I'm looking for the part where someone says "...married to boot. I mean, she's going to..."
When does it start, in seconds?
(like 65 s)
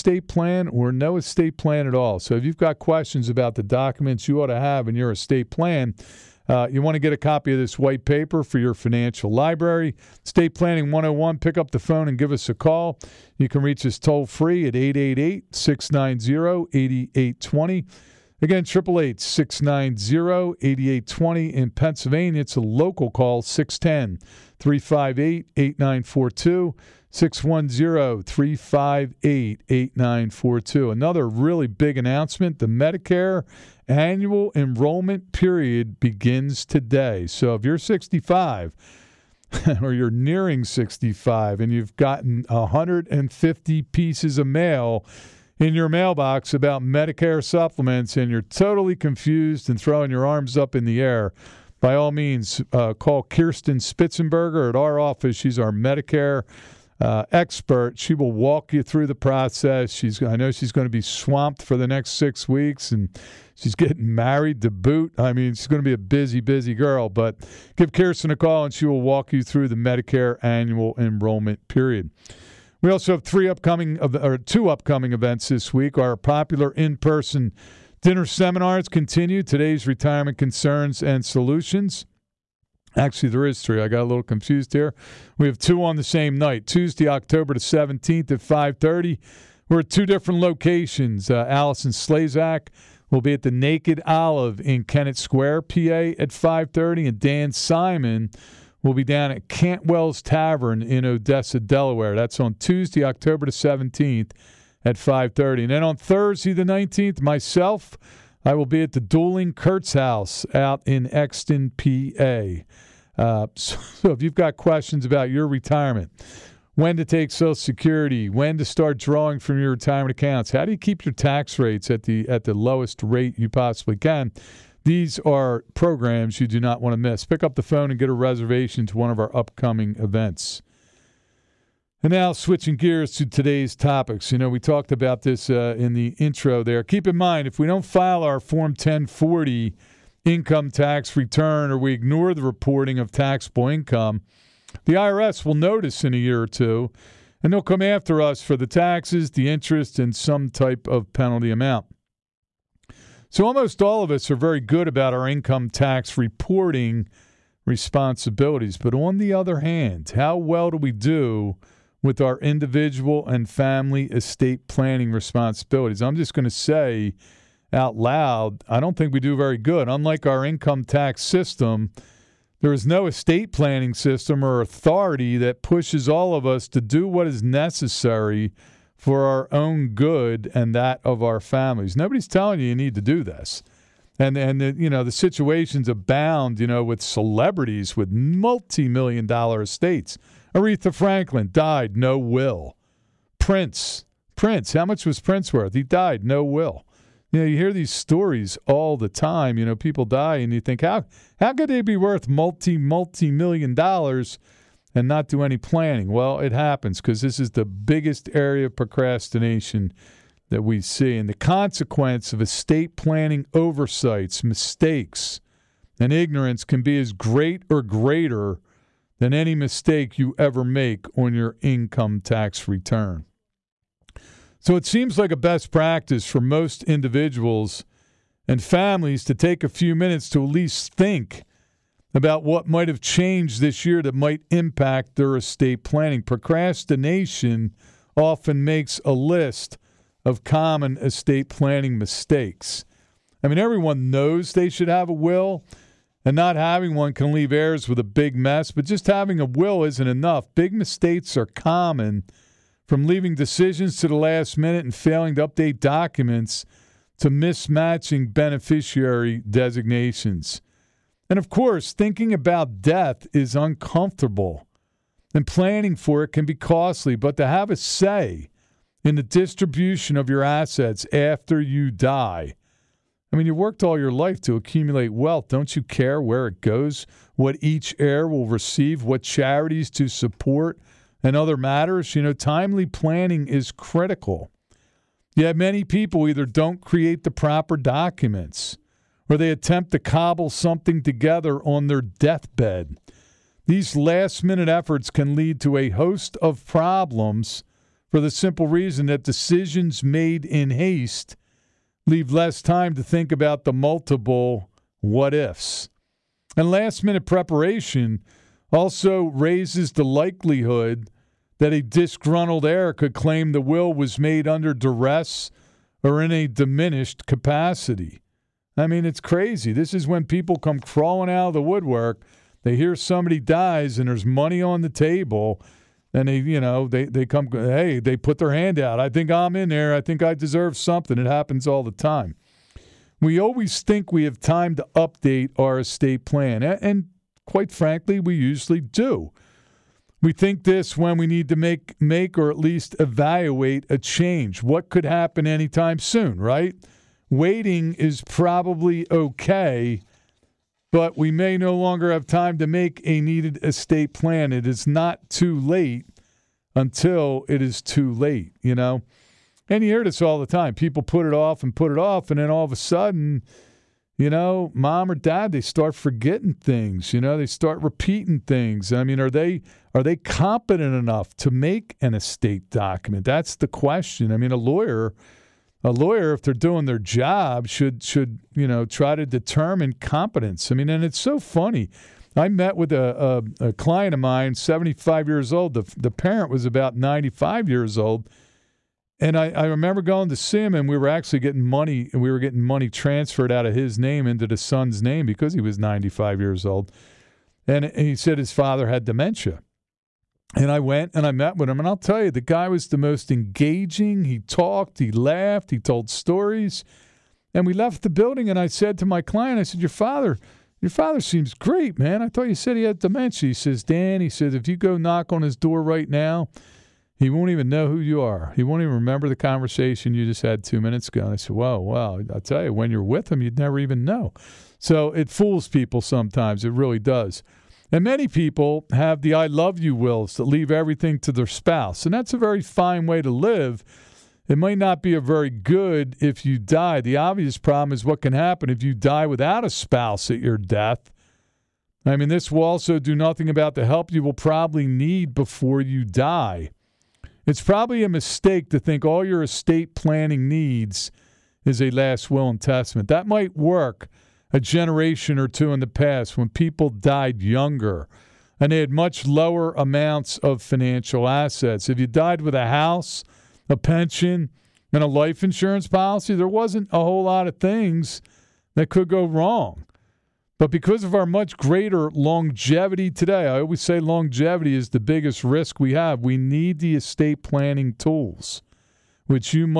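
64 s.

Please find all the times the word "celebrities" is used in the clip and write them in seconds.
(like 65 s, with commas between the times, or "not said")
187 s.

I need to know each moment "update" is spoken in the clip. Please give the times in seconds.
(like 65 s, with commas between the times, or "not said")
255 s, 334 s.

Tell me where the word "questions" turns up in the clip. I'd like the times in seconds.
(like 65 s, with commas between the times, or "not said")
2 s, 114 s, 373 s.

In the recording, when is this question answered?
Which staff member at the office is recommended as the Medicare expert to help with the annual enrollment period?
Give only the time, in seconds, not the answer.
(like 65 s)
53 s.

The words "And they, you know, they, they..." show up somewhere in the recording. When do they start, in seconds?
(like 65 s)
326 s.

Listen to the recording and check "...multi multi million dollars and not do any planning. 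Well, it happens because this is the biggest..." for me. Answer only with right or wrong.
right.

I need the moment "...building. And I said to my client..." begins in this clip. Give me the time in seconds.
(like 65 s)
408 s.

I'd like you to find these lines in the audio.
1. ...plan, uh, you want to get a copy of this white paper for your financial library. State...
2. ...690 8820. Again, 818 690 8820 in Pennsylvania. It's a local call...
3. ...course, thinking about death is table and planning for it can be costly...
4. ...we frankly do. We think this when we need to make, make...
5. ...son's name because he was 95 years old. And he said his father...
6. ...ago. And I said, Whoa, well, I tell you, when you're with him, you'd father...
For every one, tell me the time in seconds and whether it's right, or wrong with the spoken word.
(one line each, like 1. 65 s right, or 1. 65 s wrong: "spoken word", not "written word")
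1. 5 s right
2. 15 s wrong: "888", not "818"
3. 261 s wrong: "uncomfortable", not "table"
4. 338 s wrong: "usually", not "frankly"
5. 394 s right
6. 421 s wrong: "never", not "father".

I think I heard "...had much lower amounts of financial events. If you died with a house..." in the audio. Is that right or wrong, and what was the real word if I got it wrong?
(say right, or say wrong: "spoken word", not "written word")
wrong: "assets", not "events".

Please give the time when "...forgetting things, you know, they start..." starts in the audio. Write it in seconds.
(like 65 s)
365 s.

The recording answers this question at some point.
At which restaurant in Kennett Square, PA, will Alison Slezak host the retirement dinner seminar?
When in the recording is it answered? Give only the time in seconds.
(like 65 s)
93 s.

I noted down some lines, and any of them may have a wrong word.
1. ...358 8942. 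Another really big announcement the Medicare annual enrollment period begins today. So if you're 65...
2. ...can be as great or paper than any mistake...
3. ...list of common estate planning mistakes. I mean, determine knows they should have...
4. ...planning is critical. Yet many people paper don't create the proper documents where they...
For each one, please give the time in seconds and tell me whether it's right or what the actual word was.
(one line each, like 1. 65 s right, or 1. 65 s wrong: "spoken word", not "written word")
1. 28 s right
2. 216 s wrong: "greater", not "paper"
3. 239 s wrong: "everyone", not "determine"
4. 282 s wrong: "either", not "paper".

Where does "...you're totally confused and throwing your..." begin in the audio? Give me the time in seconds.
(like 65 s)
48 s.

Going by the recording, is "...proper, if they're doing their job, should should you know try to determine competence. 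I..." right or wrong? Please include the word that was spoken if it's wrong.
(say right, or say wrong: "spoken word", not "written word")
wrong: "lawyer", not "proper".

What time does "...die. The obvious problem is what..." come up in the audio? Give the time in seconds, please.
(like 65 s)
436 s.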